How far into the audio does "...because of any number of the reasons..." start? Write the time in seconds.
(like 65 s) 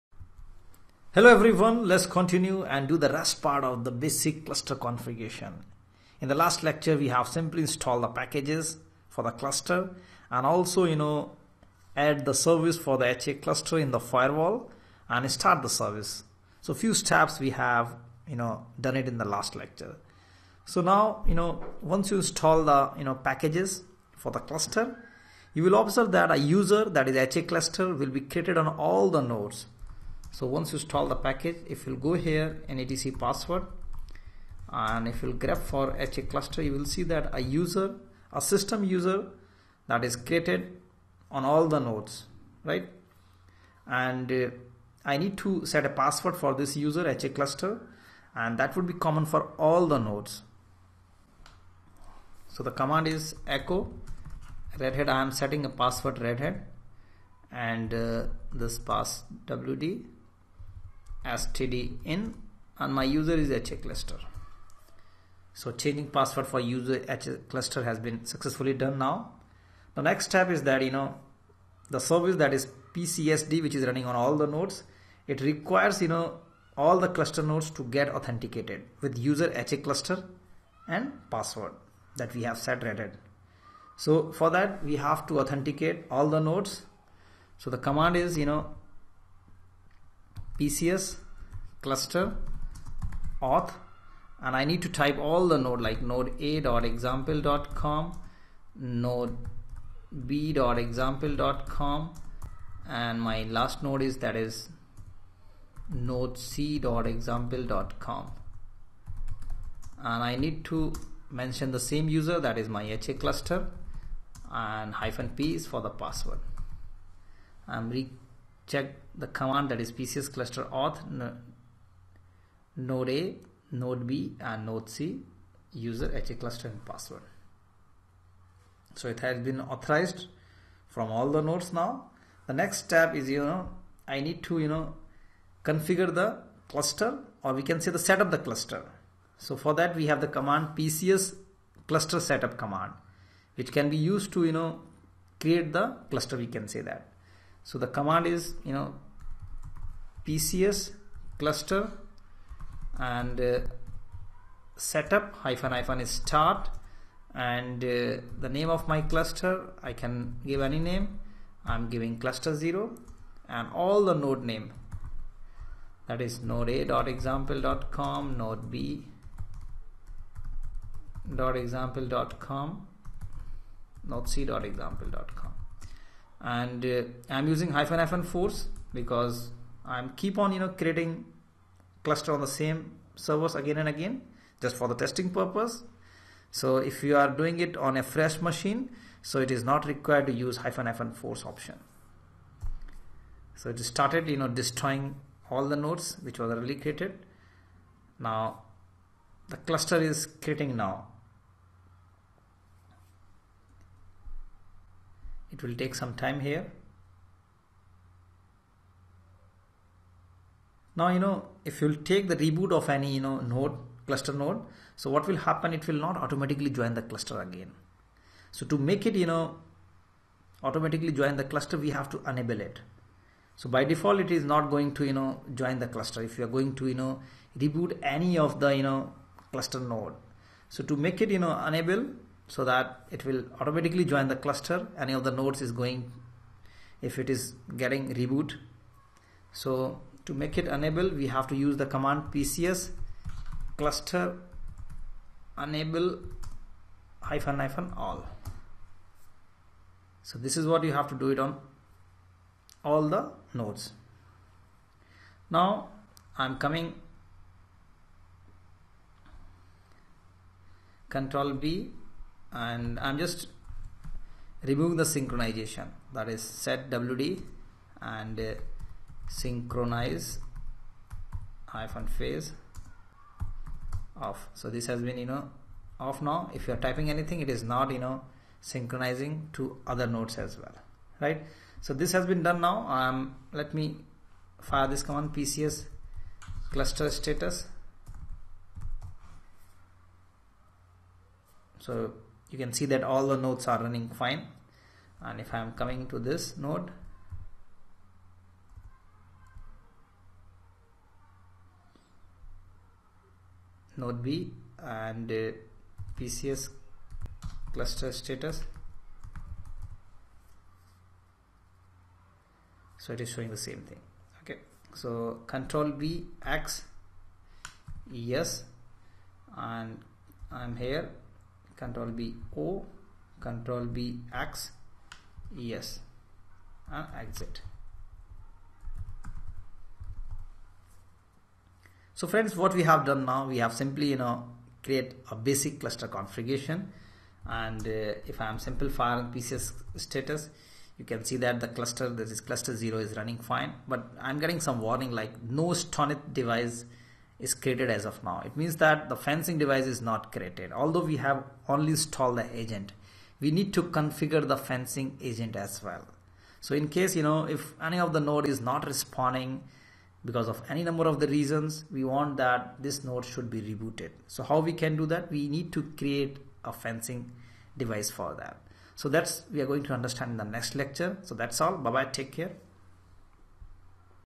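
360 s.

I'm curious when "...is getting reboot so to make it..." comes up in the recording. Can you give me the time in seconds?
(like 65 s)
237 s.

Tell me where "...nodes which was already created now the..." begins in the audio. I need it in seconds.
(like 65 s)
195 s.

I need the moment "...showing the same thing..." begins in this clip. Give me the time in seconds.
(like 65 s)
313 s.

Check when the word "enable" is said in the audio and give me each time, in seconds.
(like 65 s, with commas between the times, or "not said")
222 s, 231 s, 240 s, 245 s.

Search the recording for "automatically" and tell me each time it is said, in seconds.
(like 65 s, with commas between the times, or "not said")
216 s, 220 s, 233 s.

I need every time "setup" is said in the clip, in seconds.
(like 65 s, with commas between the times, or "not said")
138 s, 142 s, 154 s.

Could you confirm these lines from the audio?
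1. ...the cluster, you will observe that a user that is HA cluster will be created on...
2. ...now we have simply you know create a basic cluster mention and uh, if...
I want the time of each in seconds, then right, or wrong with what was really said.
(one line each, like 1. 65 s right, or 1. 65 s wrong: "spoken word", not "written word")
1. 24 s right
2. 333 s wrong: "configuration", not "mention".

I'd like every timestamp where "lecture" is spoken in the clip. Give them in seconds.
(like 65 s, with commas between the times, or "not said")
6 s, 19 s, 370 s.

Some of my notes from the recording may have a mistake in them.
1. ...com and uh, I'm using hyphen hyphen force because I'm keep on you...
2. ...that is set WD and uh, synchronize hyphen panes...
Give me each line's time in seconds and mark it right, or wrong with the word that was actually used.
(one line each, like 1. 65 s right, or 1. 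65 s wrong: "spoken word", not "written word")
1. 175 s right
2. 266 s right.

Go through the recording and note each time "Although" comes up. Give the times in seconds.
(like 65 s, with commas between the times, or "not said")
350 s.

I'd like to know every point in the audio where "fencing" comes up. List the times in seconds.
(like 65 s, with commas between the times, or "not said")
349 s, 354 s, 366 s.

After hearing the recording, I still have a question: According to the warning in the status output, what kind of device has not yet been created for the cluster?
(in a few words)
STONITH device.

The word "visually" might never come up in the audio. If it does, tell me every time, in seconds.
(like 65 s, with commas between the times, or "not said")
not said.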